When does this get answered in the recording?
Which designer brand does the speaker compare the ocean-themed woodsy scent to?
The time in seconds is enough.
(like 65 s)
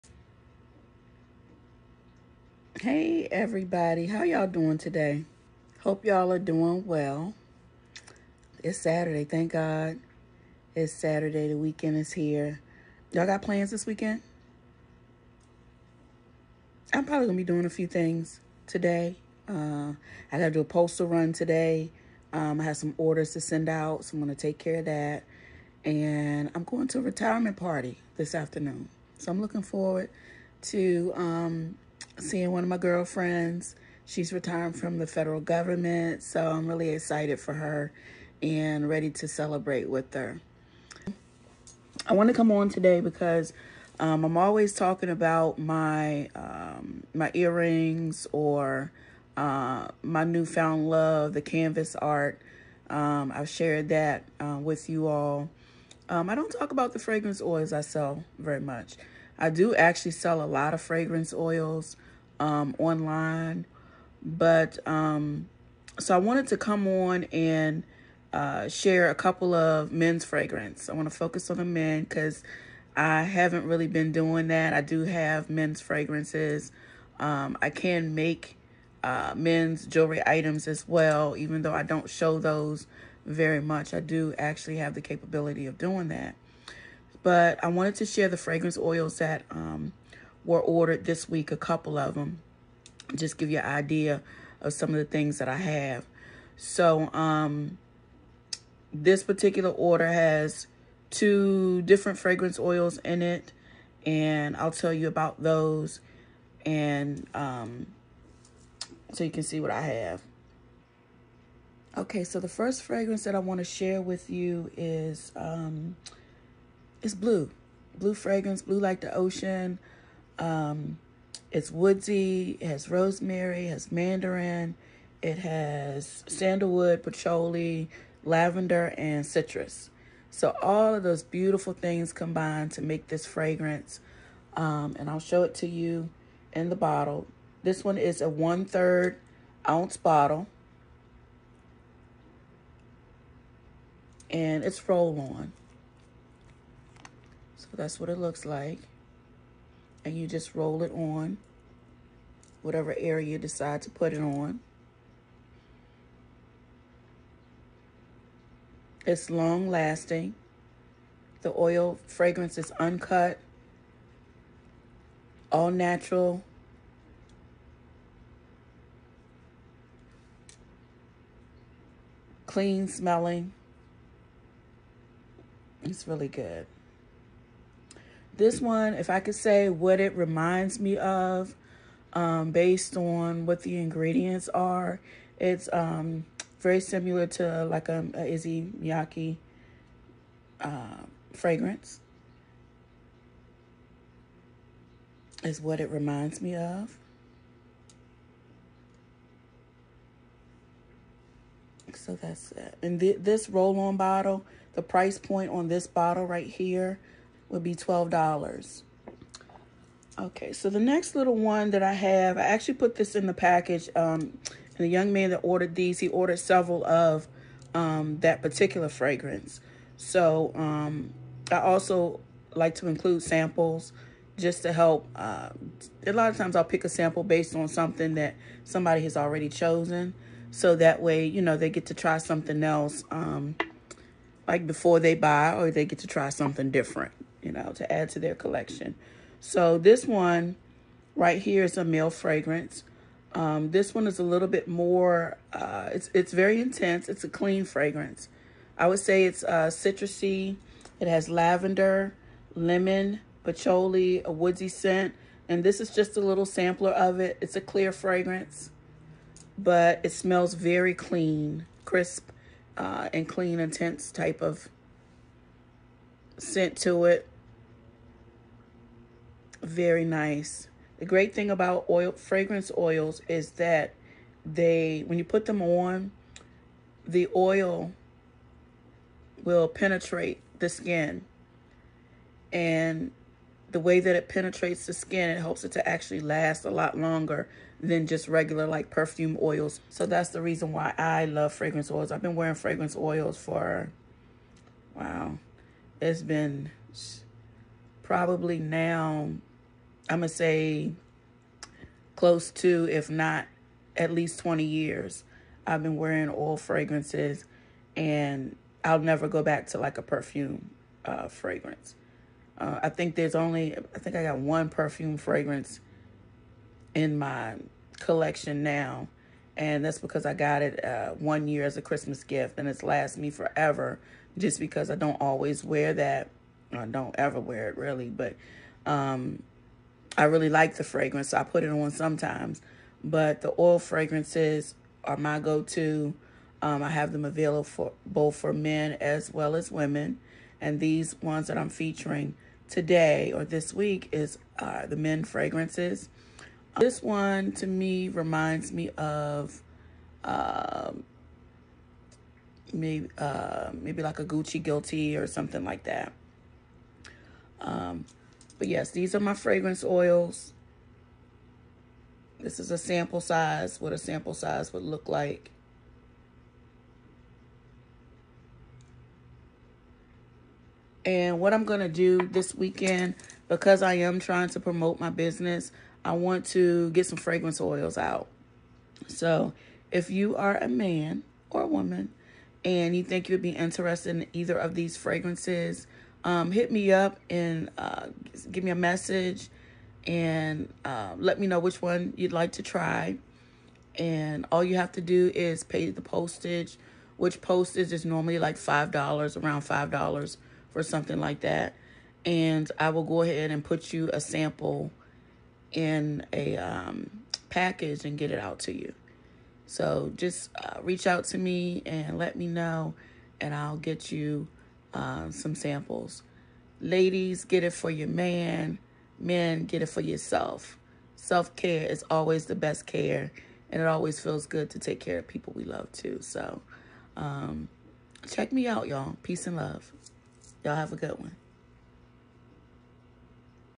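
188 s.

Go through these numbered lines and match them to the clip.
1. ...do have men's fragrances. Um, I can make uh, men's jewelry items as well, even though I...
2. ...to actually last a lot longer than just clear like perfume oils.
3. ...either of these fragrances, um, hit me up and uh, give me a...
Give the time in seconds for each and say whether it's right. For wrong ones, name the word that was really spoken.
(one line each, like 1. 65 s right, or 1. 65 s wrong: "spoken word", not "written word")
1. 74 s right
2. 285 s wrong: "regular", not "clear"
3. 384 s right.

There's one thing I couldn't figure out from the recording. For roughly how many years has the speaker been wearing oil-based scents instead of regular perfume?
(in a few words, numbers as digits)
20 years.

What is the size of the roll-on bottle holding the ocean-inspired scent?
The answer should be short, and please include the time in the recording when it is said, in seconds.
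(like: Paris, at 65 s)
One-third ounce, at 138 s.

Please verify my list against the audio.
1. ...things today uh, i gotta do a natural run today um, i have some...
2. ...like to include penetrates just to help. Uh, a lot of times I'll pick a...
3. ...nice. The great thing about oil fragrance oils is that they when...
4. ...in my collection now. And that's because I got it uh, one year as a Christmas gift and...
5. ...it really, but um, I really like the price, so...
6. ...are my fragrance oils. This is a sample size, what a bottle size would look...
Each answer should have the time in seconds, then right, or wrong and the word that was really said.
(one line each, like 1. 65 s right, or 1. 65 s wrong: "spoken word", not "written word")
1. 17 s wrong: "postal", not "natural"
2. 222 s wrong: "samples", not "penetrates"
3. 270 s right
4. 316 s right
5. 327 s wrong: "fragrance", not "price"
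6. 359 s wrong: "sample", not "bottle".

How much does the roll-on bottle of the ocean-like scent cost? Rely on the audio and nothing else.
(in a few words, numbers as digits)
$12.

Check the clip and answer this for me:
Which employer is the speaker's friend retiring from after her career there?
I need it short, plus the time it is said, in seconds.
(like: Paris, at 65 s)
Federal government, at 35 s.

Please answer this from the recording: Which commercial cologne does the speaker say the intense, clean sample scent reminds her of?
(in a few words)
Gucci Guilty.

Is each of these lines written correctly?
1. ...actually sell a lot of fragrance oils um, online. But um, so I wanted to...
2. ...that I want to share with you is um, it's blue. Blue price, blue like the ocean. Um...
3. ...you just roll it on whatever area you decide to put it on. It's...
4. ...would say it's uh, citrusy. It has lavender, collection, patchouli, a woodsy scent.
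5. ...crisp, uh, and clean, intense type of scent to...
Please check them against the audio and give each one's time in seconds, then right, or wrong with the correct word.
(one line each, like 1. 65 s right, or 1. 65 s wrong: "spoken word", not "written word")
1. 59 s right
2. 113 s wrong: "fragrance", not "price"
3. 150 s right
4. 248 s wrong: "lemon", not "collection"
5. 261 s right.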